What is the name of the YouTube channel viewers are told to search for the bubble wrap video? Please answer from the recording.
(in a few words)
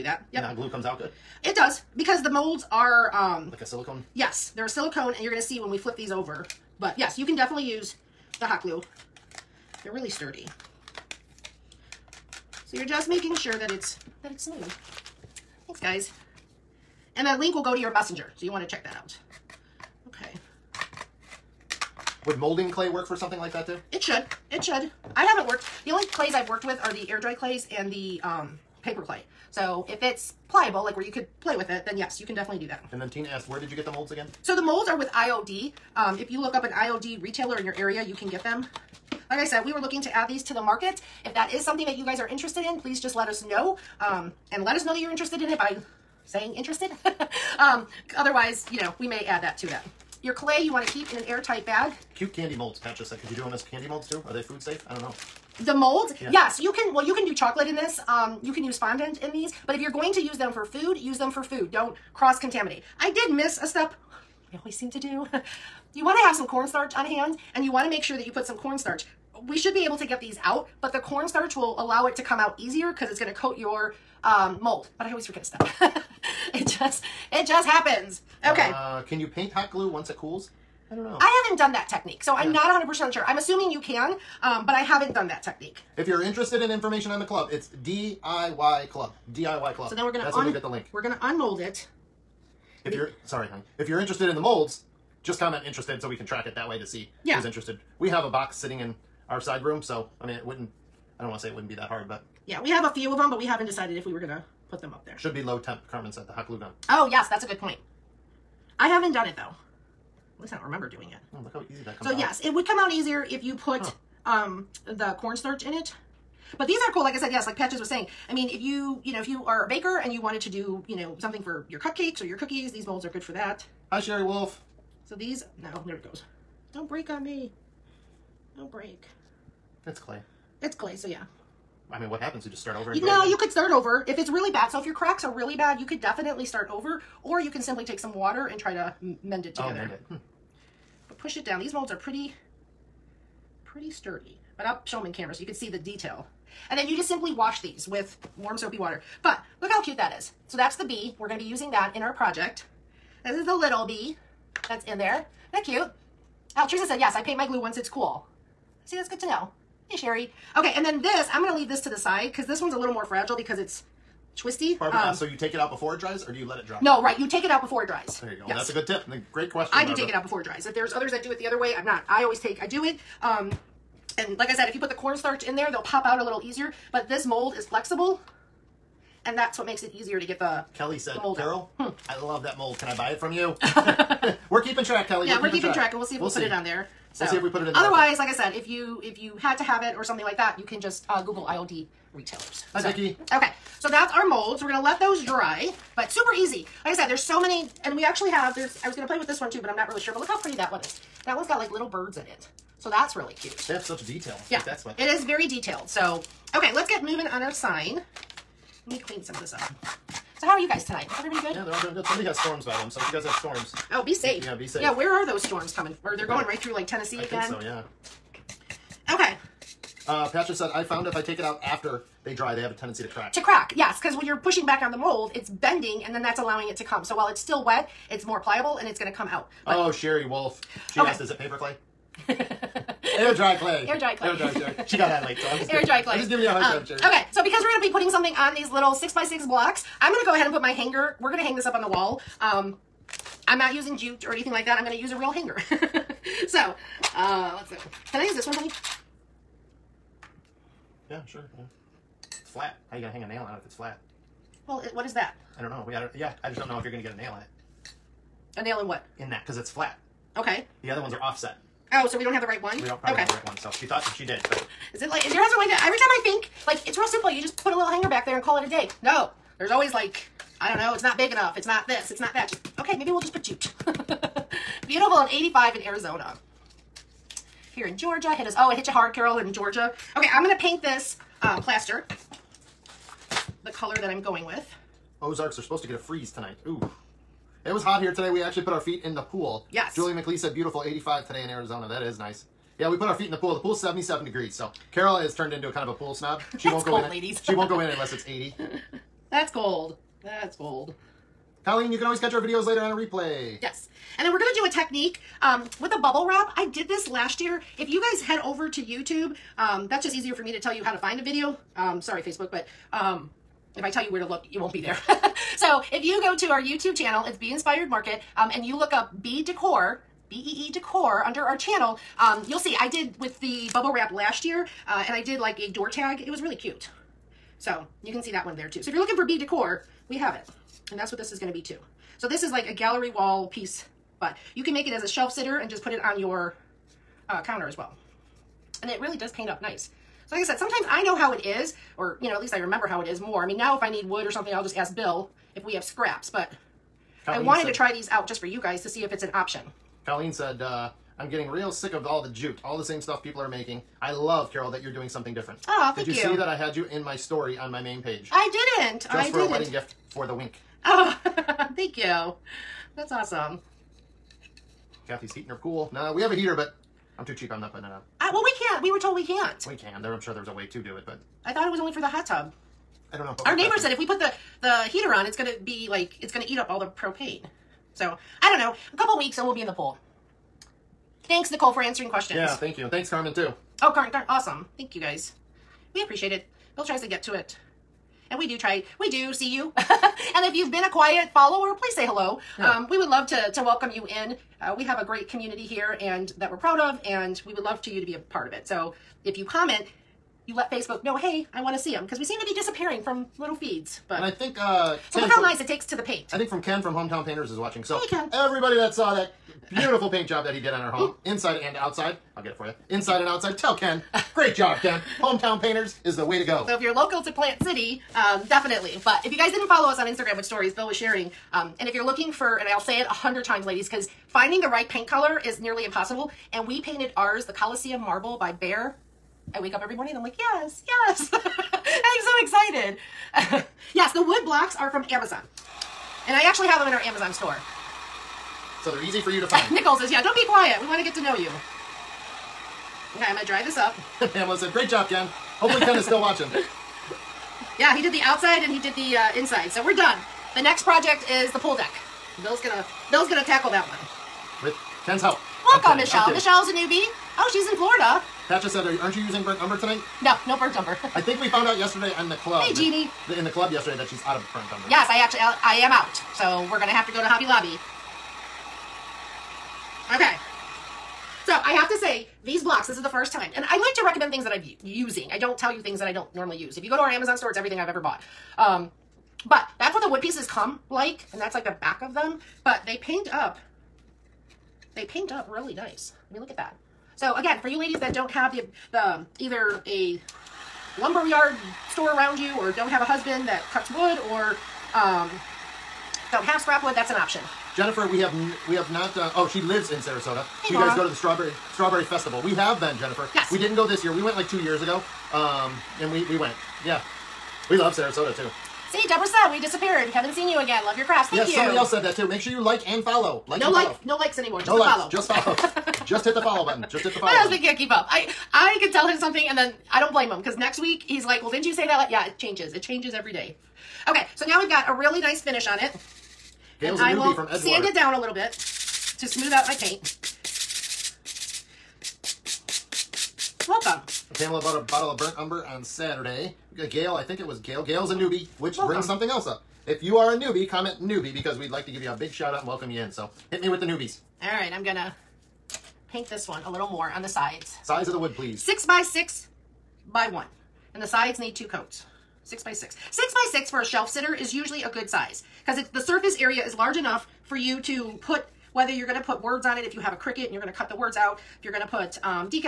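Bee Inspired Market.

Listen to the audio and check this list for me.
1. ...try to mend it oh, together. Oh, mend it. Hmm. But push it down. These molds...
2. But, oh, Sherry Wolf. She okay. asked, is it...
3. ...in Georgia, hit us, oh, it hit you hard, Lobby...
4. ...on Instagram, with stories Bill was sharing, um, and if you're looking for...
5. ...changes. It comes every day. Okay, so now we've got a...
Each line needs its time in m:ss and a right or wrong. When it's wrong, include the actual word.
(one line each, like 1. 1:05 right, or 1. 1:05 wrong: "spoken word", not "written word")
1. 2:18 right
2. 3:49 right
3. 4:37 wrong: "Carol", not "Lobby"
4. 6:59 right
5. 8:42 wrong: "changes", not "comes".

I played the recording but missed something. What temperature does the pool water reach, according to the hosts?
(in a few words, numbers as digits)
77 degrees.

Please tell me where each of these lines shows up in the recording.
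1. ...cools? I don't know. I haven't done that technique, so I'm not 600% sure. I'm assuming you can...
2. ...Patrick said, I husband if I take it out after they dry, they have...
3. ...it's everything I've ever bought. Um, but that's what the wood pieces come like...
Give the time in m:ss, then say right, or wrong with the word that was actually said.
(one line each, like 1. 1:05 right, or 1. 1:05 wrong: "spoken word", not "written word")
1. 1:20 wrong: "100", not "600"
2. 3:40 wrong: "found", not "husband"
3. 7:57 right.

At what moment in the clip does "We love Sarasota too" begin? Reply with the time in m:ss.
8:27.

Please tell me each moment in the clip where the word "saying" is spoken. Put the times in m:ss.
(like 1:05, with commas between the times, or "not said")
0:46, 1:57.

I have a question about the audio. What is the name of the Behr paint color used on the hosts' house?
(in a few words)
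Coliseum Marble.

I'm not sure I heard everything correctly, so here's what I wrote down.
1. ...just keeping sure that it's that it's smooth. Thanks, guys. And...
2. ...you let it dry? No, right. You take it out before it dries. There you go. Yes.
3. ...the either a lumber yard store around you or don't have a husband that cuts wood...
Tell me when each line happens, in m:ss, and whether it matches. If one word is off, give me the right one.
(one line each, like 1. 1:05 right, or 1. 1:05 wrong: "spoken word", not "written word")
1. 0:12 wrong: "making", not "keeping"
2. 2:46 right
3. 8:08 right.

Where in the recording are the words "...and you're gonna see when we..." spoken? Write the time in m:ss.
0:05.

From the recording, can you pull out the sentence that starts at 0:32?
And then Tina asked, where did you get the molds again?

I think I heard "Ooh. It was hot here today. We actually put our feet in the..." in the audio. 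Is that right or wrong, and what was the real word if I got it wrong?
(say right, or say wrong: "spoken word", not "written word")
right.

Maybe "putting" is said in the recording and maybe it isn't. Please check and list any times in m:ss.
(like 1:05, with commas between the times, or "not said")
3:57, 6:07.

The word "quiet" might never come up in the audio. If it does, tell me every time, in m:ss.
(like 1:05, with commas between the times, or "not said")
6:30, 7:20.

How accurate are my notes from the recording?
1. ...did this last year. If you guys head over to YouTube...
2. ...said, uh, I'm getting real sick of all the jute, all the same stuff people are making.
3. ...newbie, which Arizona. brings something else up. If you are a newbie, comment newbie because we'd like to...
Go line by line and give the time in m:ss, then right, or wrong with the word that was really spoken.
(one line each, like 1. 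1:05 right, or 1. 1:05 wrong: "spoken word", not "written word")
1. 5:06 right
2. 5:50 right
3. 8:58 wrong: "Welcome", not "Arizona".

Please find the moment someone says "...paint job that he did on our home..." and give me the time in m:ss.
6:50.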